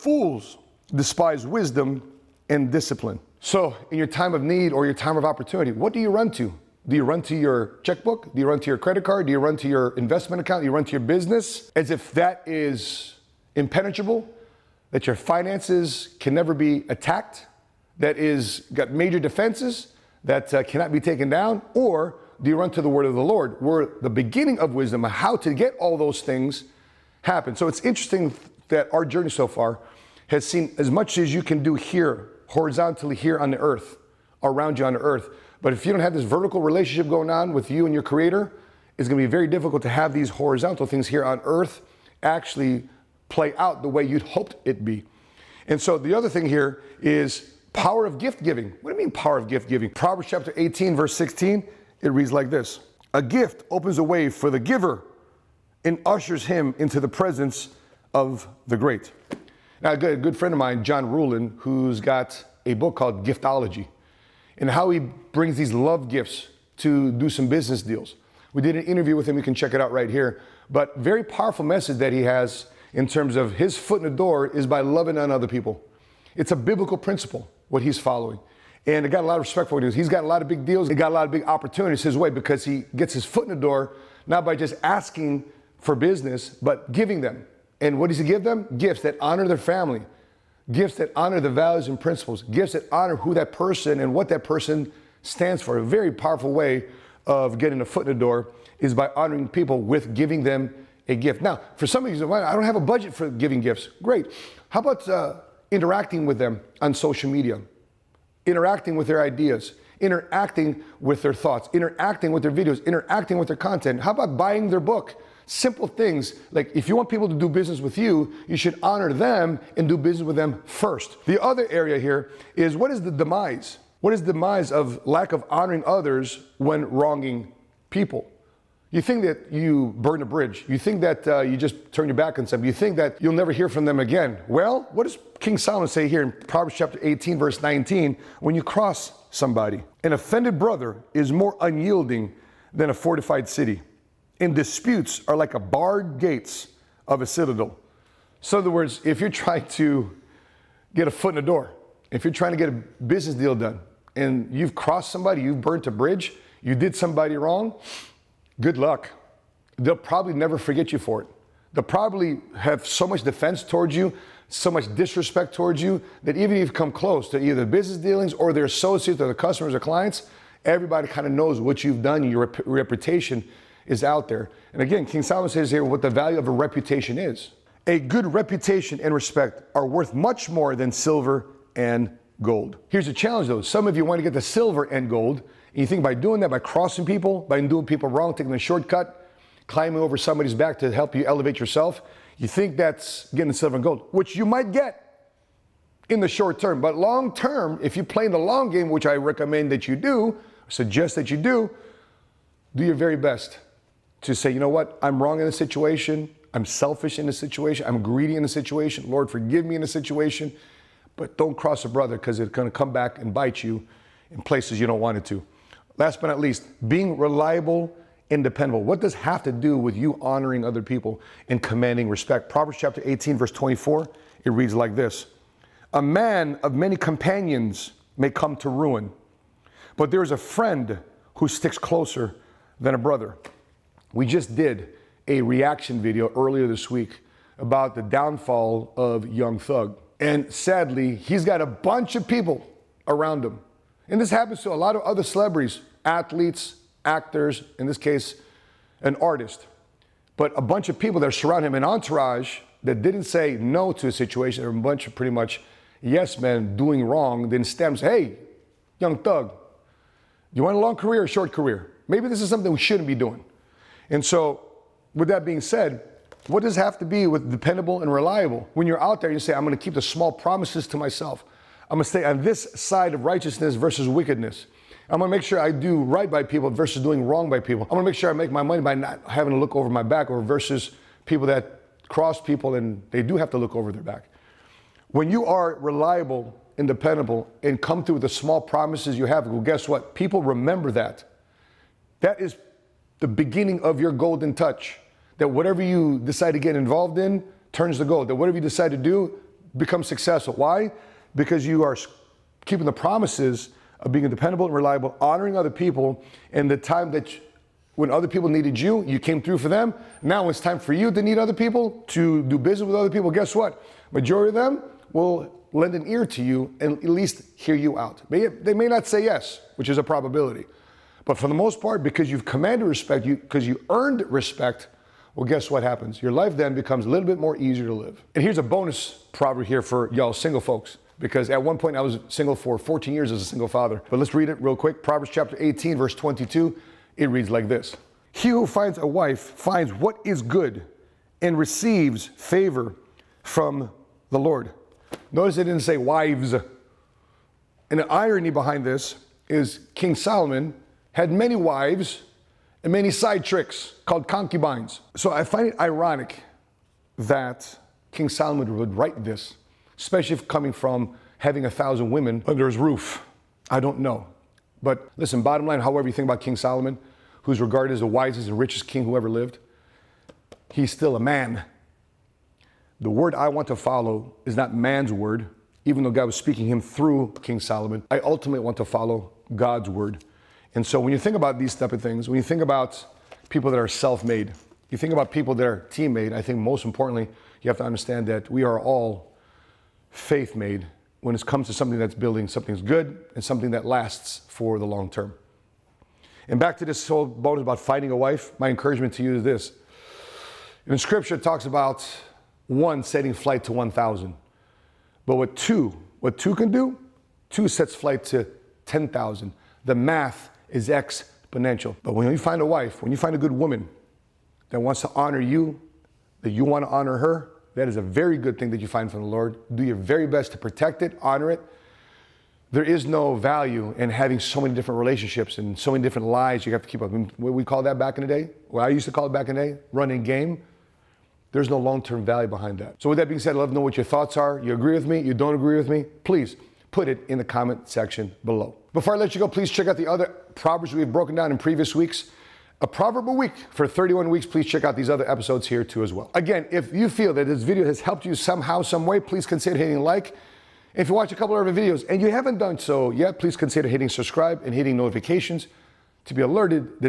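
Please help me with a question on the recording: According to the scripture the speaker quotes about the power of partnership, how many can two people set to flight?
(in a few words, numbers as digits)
10,000.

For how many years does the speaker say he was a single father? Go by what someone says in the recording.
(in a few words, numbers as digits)
14.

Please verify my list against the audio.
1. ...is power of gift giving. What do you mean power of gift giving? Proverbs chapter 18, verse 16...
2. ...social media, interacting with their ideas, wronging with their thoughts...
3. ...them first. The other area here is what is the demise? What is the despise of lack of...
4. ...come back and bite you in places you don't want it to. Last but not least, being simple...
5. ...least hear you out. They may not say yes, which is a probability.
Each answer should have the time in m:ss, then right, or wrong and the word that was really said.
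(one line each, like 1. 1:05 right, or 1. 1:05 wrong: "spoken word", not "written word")
1. 0:47 right
2. 1:46 wrong: "interacting", not "wronging"
3. 2:00 wrong: "demise", not "despise"
4. 3:32 wrong: "reliable", not "simple"
5. 5:17 right.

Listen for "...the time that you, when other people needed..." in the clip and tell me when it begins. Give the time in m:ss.
5:06.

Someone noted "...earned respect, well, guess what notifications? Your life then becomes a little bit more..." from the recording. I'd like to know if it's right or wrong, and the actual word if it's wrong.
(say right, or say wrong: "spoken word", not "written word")
wrong: "happens", not "notifications".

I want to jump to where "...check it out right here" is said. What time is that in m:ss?
1:09.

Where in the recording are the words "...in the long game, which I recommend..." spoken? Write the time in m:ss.
3:18.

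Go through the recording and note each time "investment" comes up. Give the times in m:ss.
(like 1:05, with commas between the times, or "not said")
0:09.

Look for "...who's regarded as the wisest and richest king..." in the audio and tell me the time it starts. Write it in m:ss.
6:07.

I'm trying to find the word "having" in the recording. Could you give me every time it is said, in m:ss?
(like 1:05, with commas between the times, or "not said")
4:39, 6:01, 7:04.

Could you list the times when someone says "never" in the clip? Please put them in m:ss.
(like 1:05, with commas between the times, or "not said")
0:16, 2:13, 2:40.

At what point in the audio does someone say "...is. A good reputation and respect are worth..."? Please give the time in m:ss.
2:57.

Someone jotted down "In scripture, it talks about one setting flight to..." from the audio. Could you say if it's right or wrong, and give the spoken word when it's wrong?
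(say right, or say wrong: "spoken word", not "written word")
right.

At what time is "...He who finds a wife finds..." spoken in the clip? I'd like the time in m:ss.
5:38.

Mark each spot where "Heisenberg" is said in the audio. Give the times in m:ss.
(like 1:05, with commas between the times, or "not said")
not said.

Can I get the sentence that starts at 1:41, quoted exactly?
Now, for some of you, I don't have a budget for giving gifts.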